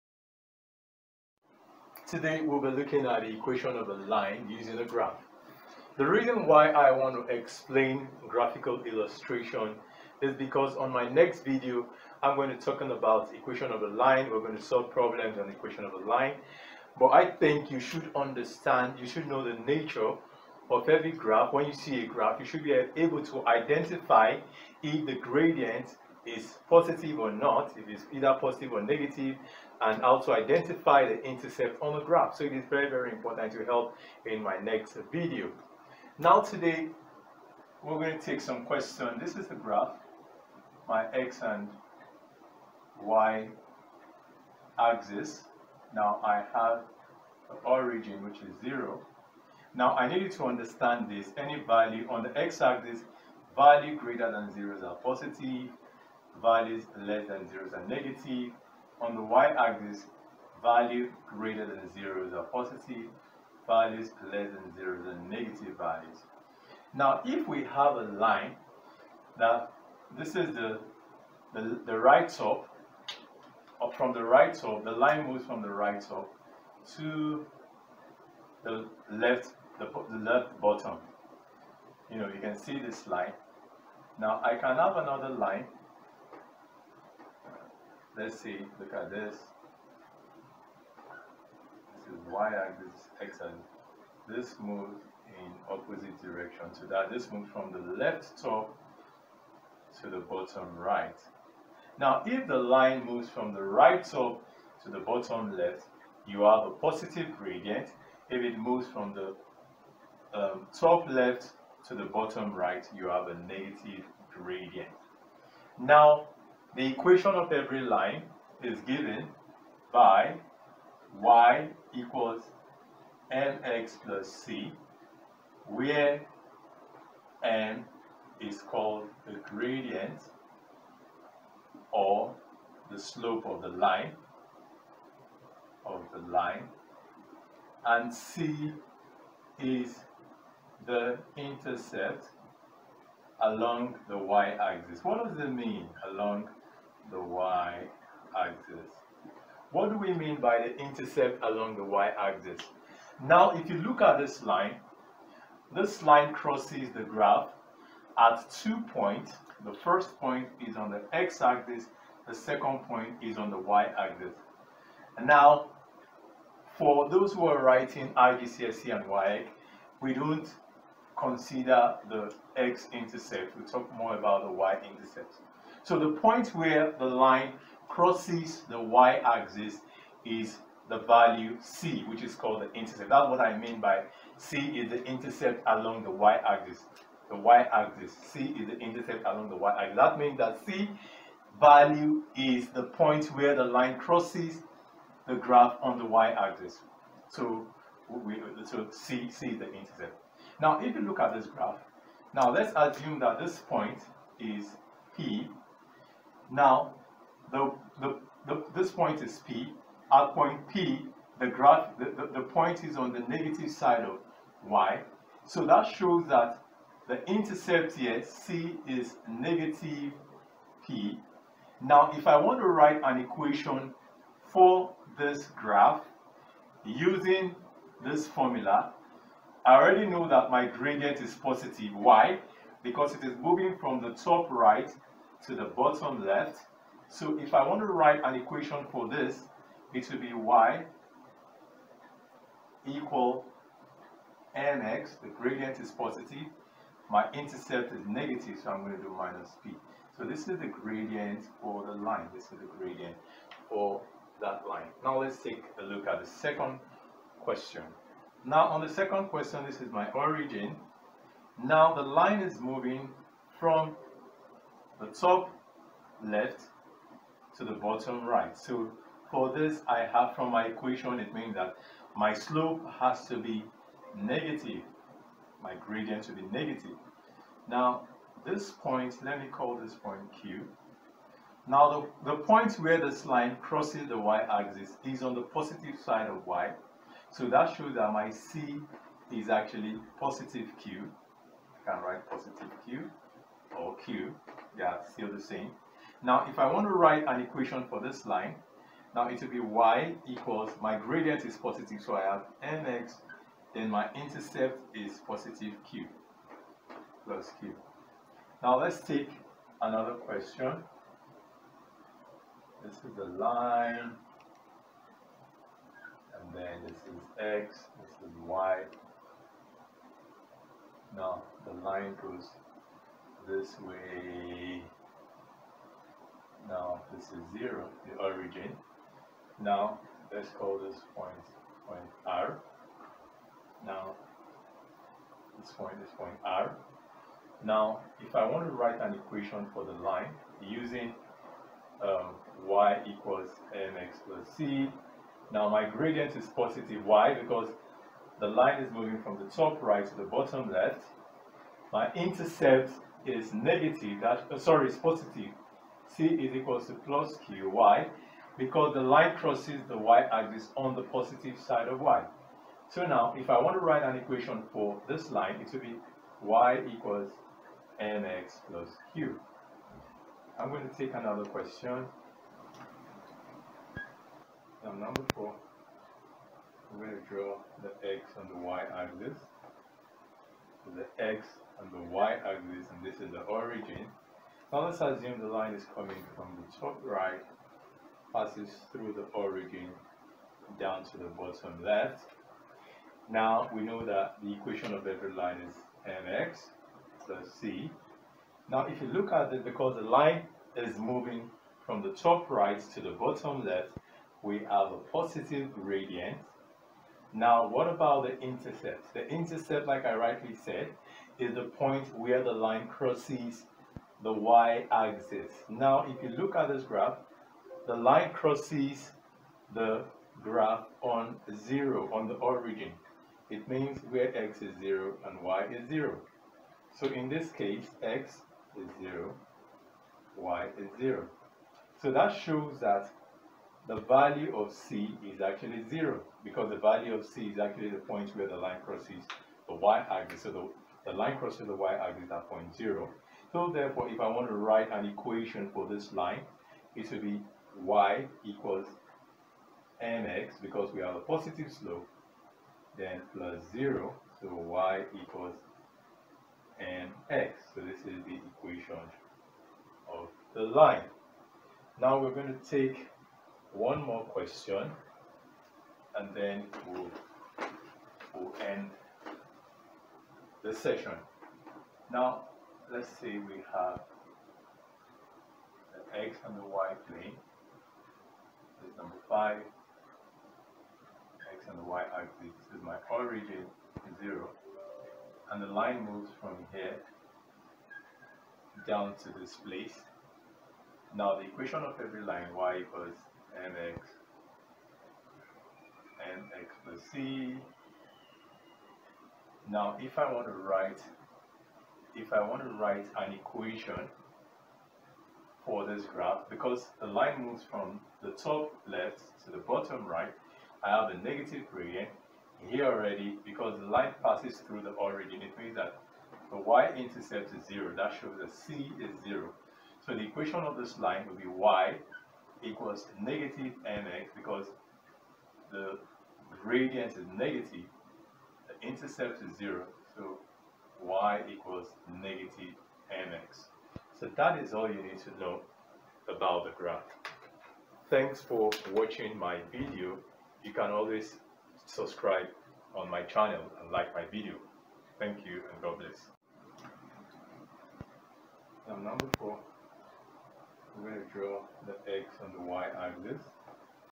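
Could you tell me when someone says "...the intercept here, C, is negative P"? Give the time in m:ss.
3:37.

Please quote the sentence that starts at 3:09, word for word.
That means that c value is the point where the line crosses the graph on the y-axis.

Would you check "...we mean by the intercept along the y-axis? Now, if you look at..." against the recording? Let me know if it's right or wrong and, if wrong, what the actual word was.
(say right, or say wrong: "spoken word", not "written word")
right.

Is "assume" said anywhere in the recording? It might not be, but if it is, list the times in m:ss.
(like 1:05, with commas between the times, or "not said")
3:22, 6:25.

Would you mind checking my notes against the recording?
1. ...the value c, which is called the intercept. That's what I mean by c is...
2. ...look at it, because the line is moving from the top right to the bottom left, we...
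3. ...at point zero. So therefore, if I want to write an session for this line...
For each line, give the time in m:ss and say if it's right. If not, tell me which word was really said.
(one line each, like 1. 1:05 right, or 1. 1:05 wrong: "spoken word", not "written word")
1. 3:00 right
2. 6:39 right
3. 7:22 wrong: "equation", not "session".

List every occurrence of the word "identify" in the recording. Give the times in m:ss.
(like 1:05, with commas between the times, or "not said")
0:23, 0:30.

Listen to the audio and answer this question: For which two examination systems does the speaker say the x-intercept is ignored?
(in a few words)
IGCSE and WAEC.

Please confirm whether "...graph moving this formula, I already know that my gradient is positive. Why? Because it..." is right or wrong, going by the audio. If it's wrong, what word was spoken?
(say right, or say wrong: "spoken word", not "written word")
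wrong: "using", not "moving".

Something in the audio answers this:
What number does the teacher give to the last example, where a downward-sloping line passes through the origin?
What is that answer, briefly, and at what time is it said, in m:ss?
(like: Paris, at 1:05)
5, at 7:58.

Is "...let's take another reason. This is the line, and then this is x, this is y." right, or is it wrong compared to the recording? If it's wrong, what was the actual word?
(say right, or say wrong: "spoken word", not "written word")
wrong: "question", not "reason".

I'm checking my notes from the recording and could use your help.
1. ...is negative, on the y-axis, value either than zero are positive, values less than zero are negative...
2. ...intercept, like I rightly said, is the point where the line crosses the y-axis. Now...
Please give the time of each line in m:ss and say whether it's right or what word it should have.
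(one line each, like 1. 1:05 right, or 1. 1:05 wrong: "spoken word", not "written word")
1. 0:57 wrong: "greater", not "either"
2. 6:49 right.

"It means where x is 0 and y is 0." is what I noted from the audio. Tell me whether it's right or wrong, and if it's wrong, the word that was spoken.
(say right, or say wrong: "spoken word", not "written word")
right.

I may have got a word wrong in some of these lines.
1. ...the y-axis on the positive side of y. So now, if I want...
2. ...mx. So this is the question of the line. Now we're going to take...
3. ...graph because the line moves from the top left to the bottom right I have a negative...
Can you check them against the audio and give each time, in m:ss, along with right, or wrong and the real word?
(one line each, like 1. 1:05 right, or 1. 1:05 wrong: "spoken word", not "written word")
1. 5:59 right
2. 7:36 wrong: "equation", not "question"
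3. 8:26 right.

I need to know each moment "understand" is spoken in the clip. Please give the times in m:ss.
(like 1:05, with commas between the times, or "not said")
0:18, 0:50.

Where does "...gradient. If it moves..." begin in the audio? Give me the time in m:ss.
1:47.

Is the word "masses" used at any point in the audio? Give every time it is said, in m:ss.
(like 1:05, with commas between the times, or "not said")
not said.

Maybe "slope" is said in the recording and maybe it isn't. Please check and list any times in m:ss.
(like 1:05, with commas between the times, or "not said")
2:12, 4:32, 7:31.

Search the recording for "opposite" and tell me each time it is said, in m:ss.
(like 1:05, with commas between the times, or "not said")
1:35.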